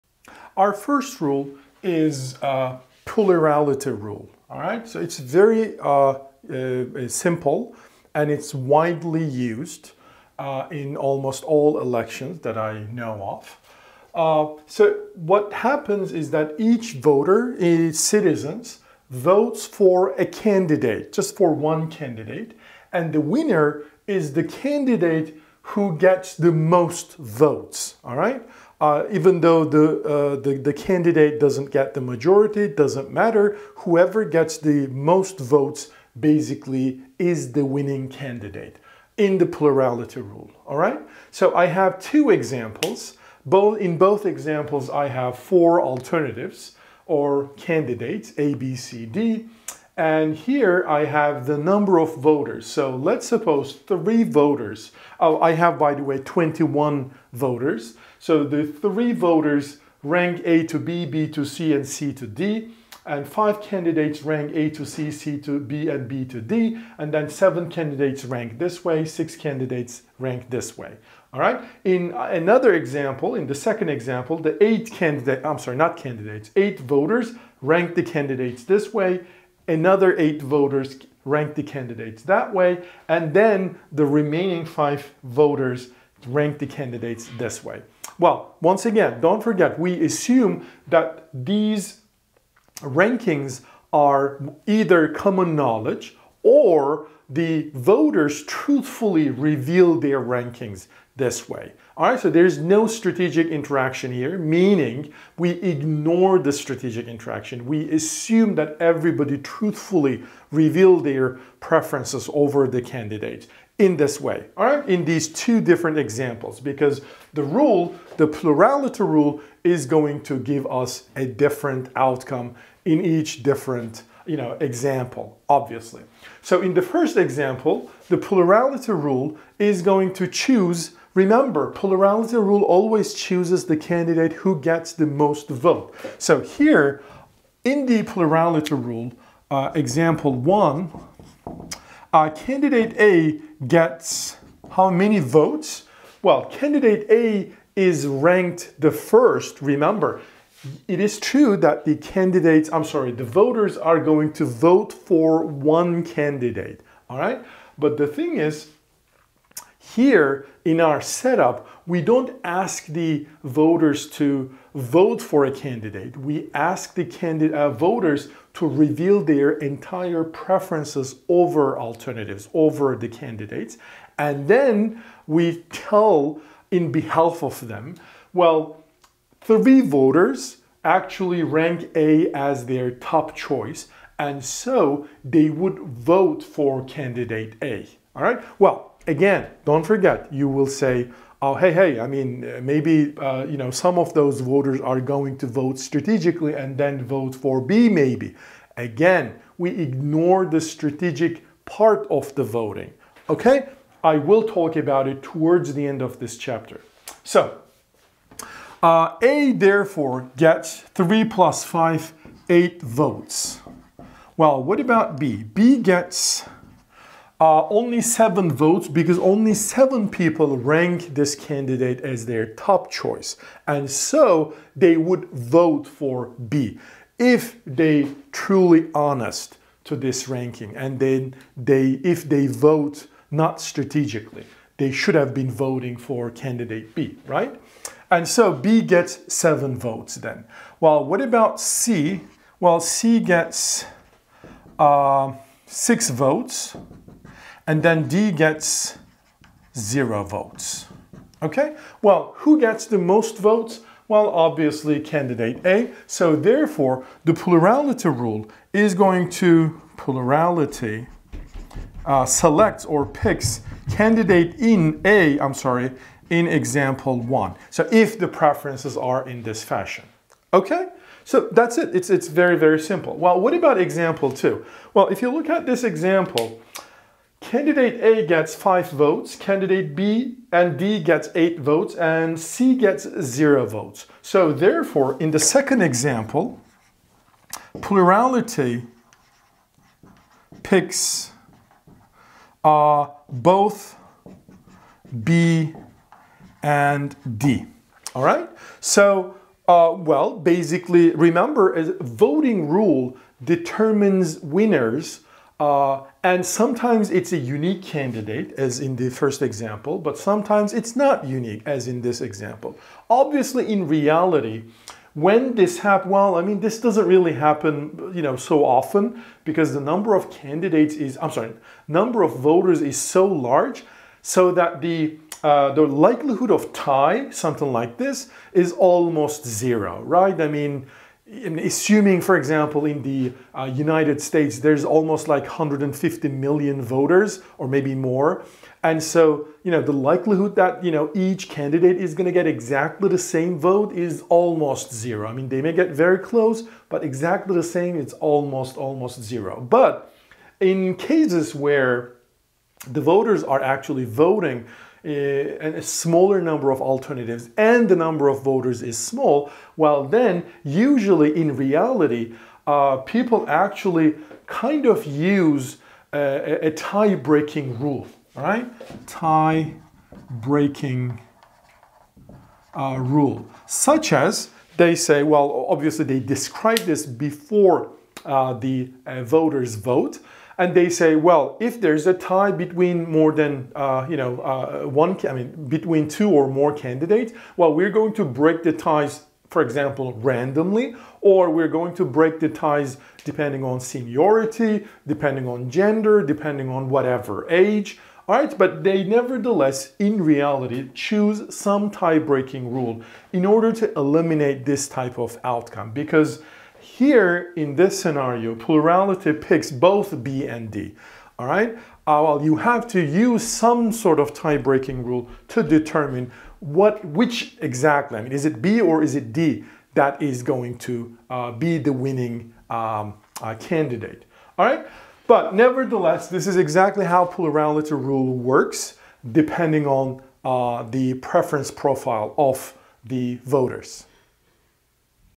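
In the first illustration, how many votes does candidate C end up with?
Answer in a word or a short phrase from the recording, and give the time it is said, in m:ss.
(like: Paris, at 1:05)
6, at 4:05.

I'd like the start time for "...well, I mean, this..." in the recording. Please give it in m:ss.
5:16.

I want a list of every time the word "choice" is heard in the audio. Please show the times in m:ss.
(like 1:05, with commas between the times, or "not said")
3:03, 3:42.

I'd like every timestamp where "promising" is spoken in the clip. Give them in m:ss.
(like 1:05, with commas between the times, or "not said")
not said.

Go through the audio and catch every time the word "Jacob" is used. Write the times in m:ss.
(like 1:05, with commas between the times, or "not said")
not said.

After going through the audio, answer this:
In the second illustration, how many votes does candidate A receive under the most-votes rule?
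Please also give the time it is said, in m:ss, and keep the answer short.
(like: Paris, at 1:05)
5, at 4:38.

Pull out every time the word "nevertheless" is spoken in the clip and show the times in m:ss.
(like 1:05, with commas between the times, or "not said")
6:39, 7:05.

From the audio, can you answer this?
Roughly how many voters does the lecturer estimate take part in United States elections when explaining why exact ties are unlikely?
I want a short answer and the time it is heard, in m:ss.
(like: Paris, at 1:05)
150 million, at 5:35.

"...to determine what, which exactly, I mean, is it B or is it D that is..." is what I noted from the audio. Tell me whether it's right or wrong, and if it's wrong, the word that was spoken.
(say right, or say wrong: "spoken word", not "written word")
right.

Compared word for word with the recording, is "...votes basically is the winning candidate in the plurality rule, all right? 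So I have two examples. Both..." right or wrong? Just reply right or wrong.
right.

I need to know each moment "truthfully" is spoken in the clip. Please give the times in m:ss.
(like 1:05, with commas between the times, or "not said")
1:38, 1:49.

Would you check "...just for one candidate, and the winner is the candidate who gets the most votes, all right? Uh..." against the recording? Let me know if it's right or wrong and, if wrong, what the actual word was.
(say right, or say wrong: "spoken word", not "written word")
right.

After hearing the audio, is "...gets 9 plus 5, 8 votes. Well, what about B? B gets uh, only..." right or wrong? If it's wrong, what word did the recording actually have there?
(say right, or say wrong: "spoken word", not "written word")
wrong: "3", not "9".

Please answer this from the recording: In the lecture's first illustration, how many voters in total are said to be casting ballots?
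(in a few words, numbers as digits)
21.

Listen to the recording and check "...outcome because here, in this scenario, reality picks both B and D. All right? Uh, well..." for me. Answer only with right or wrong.
wrong.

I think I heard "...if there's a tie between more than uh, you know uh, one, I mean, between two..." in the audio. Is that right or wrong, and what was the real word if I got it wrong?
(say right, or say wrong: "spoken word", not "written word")
right.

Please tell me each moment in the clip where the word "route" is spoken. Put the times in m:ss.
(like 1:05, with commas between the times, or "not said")
not said.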